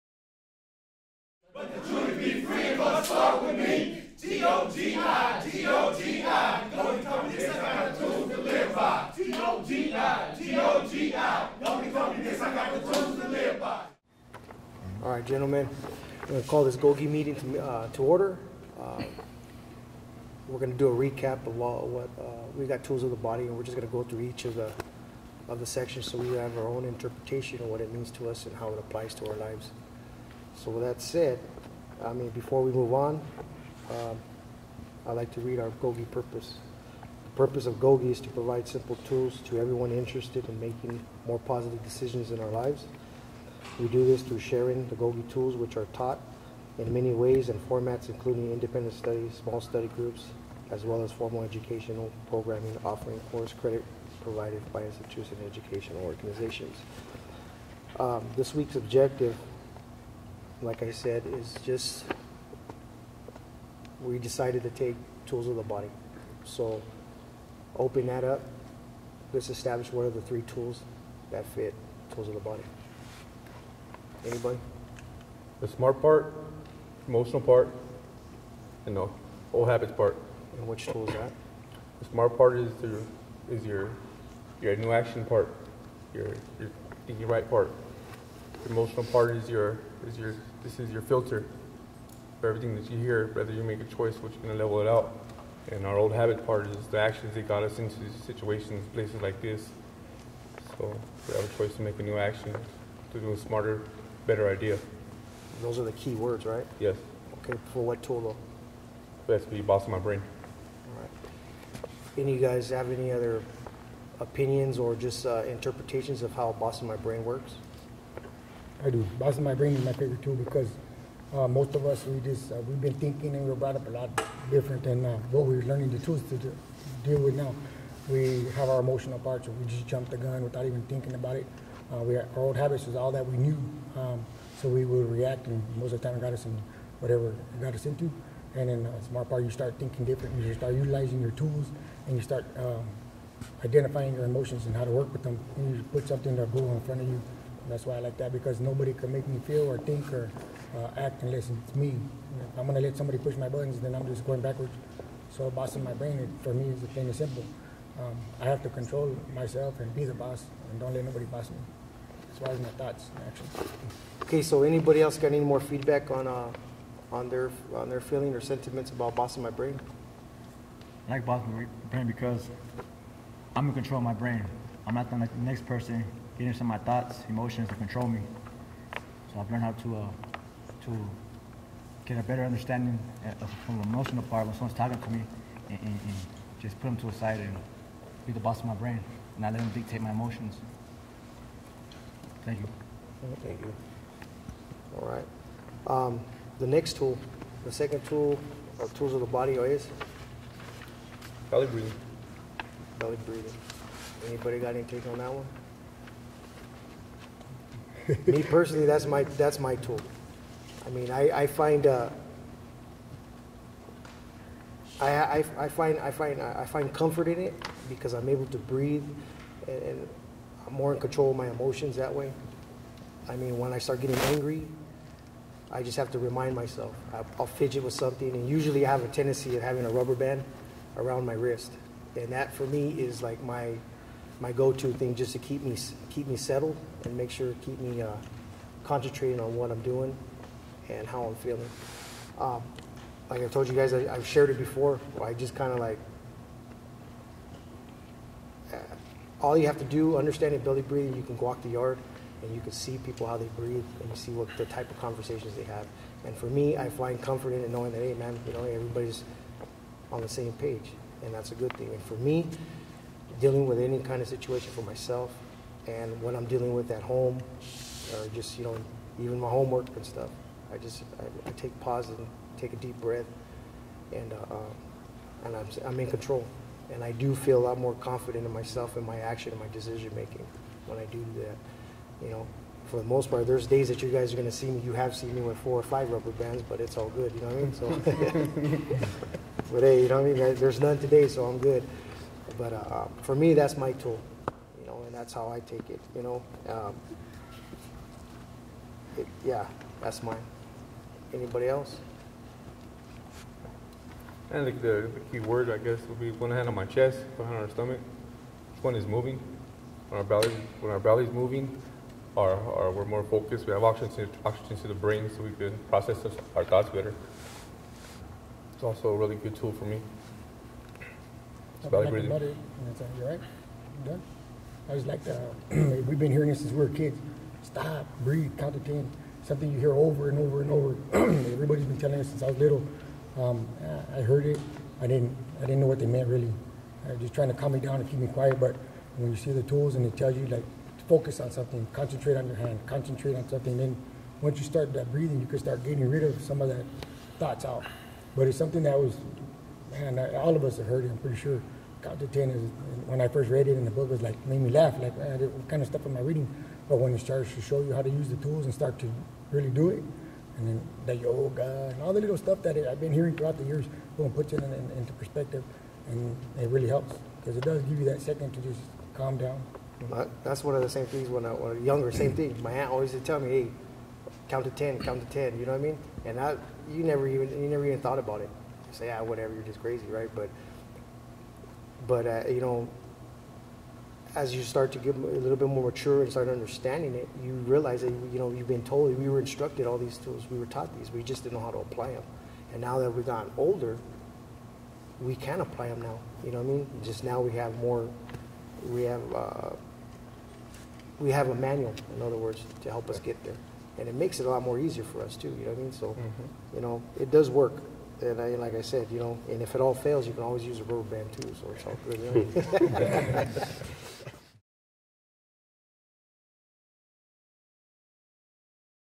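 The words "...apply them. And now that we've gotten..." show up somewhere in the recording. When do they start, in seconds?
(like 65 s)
391 s.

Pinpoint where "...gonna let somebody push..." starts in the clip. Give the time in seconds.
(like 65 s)
152 s.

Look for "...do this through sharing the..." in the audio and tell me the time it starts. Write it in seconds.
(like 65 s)
43 s.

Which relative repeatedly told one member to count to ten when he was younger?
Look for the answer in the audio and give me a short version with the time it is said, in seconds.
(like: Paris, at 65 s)
aunt, at 372 s.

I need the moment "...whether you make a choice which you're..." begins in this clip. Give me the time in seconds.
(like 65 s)
93 s.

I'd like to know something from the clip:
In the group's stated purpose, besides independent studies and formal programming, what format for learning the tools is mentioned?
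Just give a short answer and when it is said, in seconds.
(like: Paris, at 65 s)
small study groups, at 49 s.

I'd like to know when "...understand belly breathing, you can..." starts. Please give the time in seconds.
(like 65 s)
250 s.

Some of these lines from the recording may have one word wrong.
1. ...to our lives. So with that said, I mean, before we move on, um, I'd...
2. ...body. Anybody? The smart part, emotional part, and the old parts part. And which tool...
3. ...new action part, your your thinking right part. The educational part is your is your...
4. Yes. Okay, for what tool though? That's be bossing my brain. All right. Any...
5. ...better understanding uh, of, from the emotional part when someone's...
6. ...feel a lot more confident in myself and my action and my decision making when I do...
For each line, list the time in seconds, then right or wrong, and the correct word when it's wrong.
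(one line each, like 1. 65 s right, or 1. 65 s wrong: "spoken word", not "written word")
1. 29 s right
2. 72 s wrong: "habits", not "parts"
3. 84 s wrong: "emotional", not "educational"
4. 106 s right
5. 182 s right
6. 277 s right.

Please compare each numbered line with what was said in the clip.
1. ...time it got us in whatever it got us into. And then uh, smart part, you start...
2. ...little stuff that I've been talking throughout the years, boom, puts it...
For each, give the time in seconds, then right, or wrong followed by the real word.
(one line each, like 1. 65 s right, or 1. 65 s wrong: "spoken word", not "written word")
1. 136 s right
2. 362 s wrong: "hearing", not "talking".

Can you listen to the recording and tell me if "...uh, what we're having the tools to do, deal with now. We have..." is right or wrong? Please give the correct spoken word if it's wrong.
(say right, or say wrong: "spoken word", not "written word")
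wrong: "learning", not "having".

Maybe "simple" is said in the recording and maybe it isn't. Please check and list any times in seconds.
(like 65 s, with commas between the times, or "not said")
38 s, 157 s.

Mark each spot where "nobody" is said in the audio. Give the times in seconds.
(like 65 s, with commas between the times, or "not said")
148 s, 161 s.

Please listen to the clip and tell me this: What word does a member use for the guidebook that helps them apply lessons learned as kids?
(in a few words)
manual.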